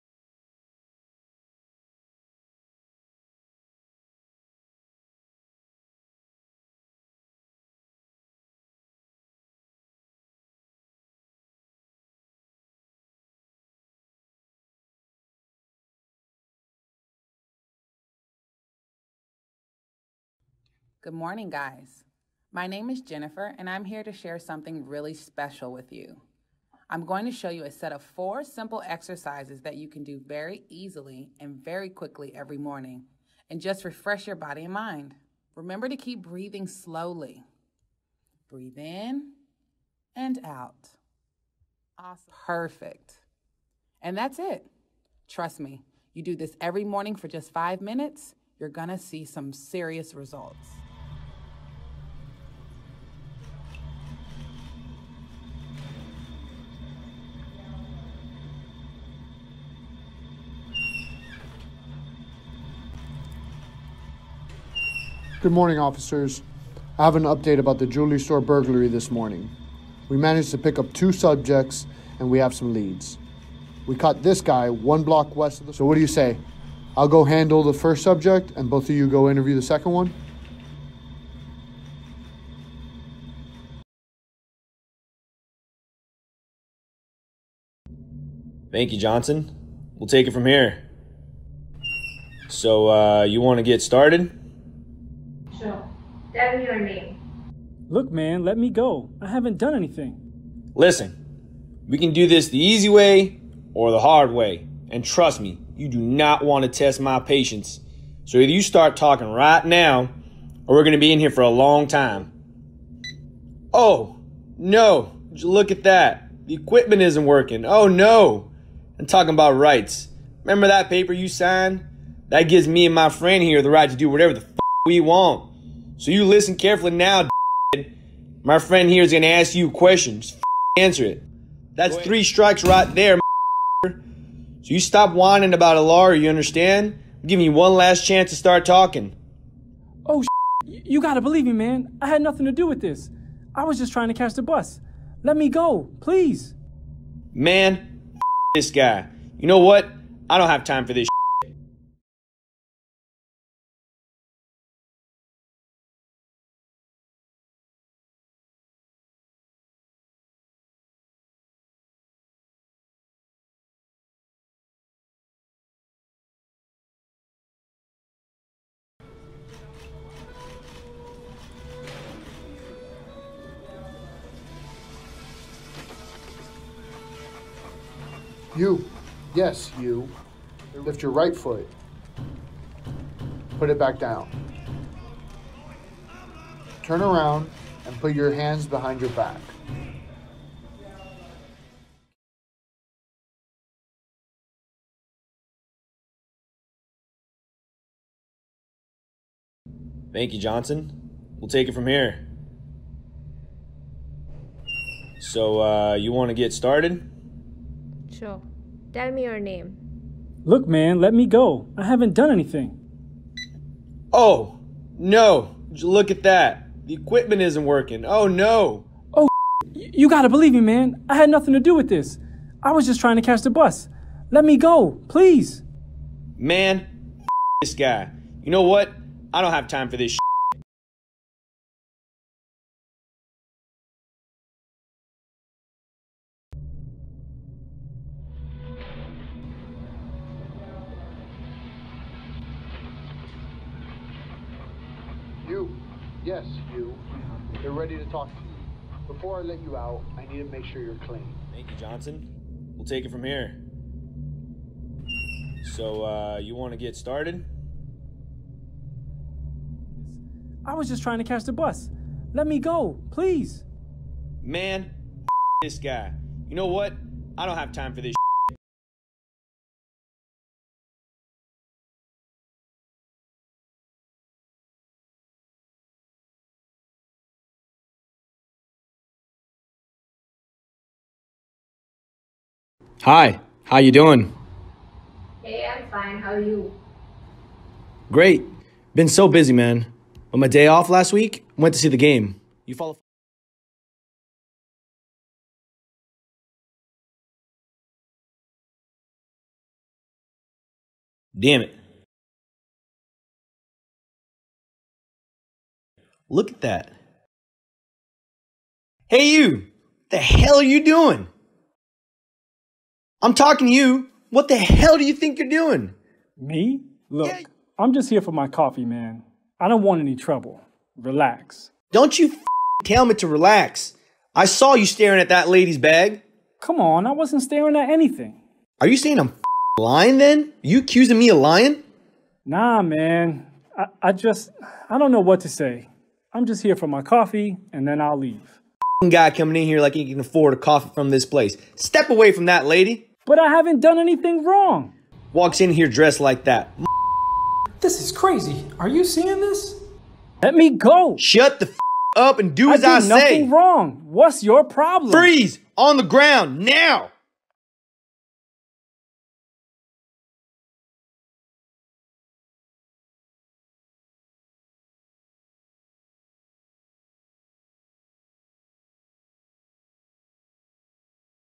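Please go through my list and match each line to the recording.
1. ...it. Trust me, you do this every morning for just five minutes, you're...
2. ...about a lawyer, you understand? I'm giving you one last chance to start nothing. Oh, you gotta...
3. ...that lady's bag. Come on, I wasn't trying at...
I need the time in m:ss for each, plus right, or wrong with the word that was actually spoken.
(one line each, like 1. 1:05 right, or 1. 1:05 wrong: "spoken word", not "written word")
1. 0:44 right
2. 2:15 wrong: "talking", not "nothing"
3. 5:25 wrong: "staring", not "trying".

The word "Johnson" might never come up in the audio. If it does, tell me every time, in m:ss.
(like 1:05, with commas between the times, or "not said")
1:28, 3:20, 4:11.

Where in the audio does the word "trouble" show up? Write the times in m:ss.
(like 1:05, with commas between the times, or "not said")
5:20.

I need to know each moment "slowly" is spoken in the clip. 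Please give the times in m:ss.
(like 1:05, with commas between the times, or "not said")
0:36.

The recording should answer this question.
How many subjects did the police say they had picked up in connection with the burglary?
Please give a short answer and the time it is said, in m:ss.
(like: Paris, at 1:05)
2, at 1:10.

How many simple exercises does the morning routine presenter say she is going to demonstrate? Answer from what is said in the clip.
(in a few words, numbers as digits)
4.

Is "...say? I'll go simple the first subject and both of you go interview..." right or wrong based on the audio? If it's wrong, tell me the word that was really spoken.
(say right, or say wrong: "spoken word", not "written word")
wrong: "handle", not "simple".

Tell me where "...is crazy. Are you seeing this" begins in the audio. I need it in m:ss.
5:48.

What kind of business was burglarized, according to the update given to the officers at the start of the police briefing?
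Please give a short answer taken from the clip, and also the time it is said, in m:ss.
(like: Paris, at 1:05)
Jewelry store, at 1:07.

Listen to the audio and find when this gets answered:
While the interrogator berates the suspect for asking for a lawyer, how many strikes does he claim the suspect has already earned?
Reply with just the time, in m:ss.
2:11.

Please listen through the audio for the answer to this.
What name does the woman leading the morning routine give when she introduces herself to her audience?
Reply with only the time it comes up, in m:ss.
0:23.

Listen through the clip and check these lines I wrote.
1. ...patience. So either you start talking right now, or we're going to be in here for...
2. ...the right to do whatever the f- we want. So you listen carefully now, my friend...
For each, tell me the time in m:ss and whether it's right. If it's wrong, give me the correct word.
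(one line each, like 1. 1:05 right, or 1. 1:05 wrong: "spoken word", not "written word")
1. 1:47 right
2. 2:03 right.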